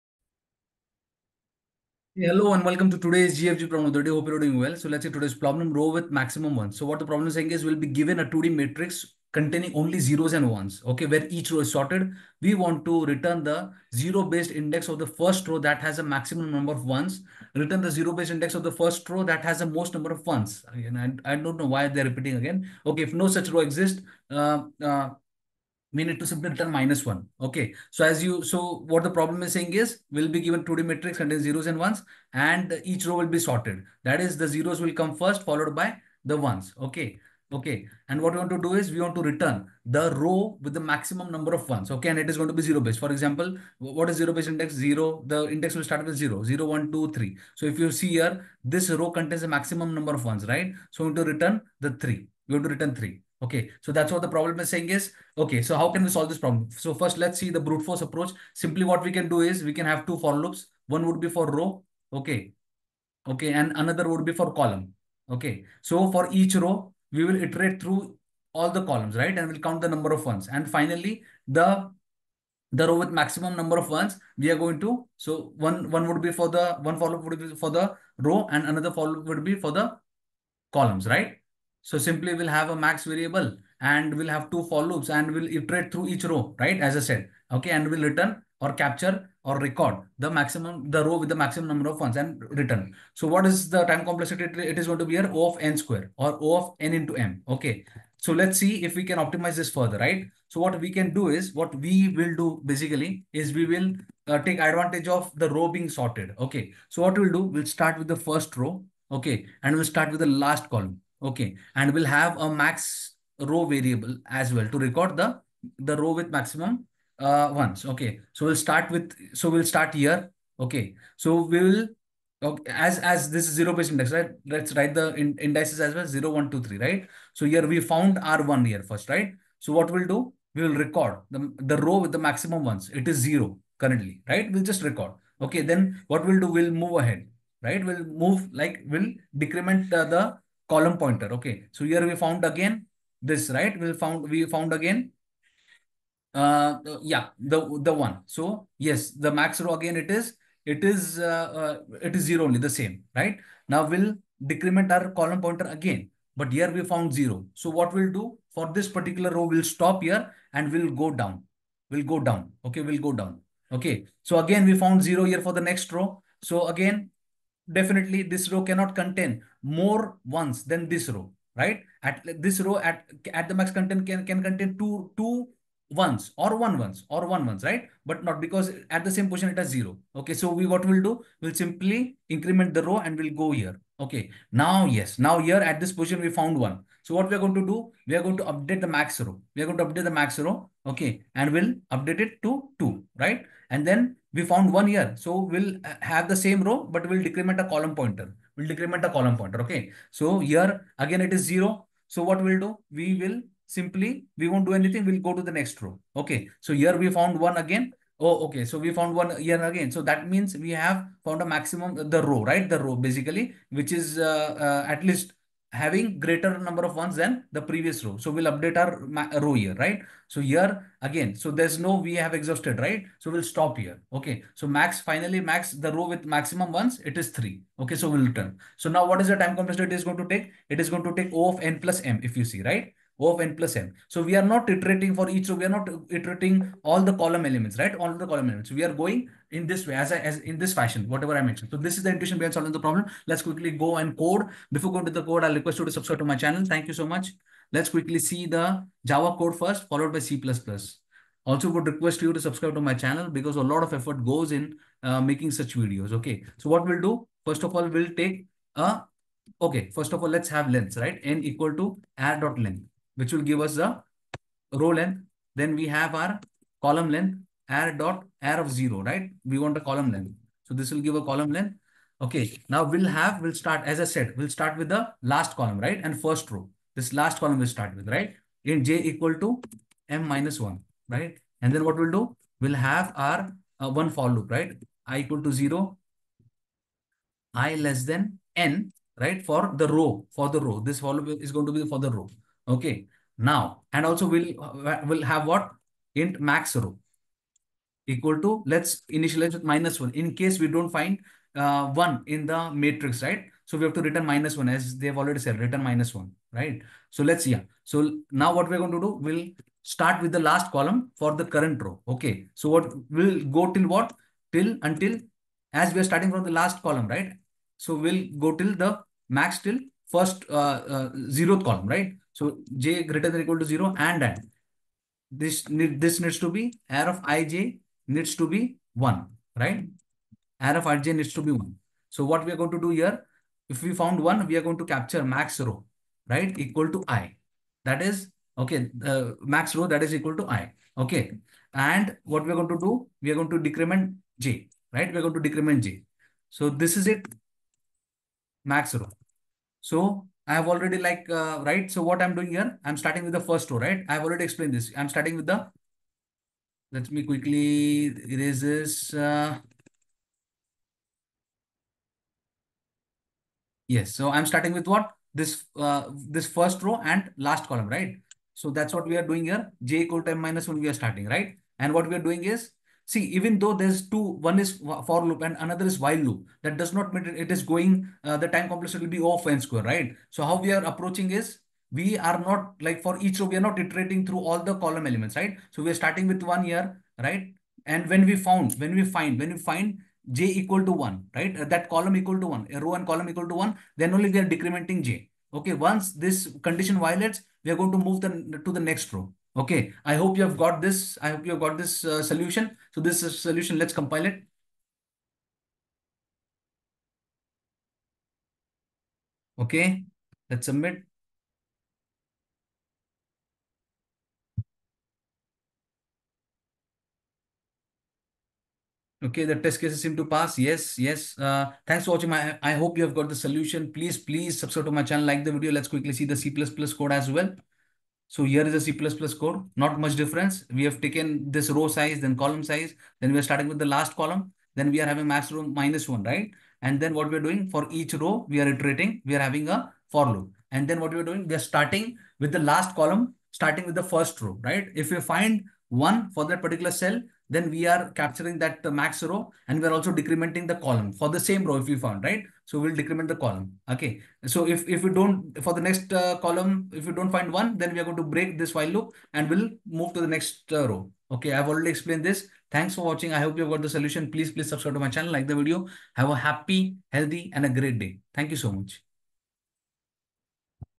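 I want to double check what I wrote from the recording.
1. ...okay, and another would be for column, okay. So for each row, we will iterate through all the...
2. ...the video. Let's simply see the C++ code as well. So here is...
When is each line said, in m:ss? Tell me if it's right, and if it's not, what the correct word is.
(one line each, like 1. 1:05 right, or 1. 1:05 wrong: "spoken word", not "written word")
1. 1:03 right
2. 7:05 wrong: "quickly", not "simply".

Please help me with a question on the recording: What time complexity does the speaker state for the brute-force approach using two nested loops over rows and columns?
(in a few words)
O of n into m.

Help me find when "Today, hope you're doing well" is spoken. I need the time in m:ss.
0:03.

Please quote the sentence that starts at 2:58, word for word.
But not because at the same position it has zero.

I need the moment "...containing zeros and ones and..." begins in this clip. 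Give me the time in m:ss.
0:31.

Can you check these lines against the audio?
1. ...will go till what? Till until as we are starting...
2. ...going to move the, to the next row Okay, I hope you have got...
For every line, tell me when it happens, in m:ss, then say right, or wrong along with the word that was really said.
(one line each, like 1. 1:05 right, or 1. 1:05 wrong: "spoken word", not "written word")
1. 5:13 right
2. 6:37 right.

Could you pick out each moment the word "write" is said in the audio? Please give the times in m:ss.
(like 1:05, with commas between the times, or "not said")
2:04.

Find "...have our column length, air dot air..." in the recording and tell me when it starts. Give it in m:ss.
4:25.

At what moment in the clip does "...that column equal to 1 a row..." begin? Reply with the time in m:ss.
6:31.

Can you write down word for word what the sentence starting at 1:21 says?
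So simply we'll have a max variable and we'll have two for loops and we'll iterate through each row, right?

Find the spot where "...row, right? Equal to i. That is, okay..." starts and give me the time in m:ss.
5:35.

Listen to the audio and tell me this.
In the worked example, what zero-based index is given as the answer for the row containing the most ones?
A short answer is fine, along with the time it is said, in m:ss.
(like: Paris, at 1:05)
3, at 0:50.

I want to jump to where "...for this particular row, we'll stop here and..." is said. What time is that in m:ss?
2:38.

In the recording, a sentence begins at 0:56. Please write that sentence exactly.
So first, let's see the brute force approach.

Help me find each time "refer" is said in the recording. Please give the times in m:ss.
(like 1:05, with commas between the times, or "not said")
not said.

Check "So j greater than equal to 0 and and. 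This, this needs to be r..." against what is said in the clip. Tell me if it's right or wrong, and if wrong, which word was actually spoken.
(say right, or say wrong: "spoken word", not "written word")
right.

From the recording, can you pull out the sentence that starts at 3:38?
So we'll update our row here, right?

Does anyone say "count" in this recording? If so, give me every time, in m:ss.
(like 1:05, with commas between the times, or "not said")
1:09.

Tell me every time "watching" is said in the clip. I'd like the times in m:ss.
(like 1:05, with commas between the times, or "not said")
7:02, 7:43.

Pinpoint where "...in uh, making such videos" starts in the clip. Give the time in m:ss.
4:14.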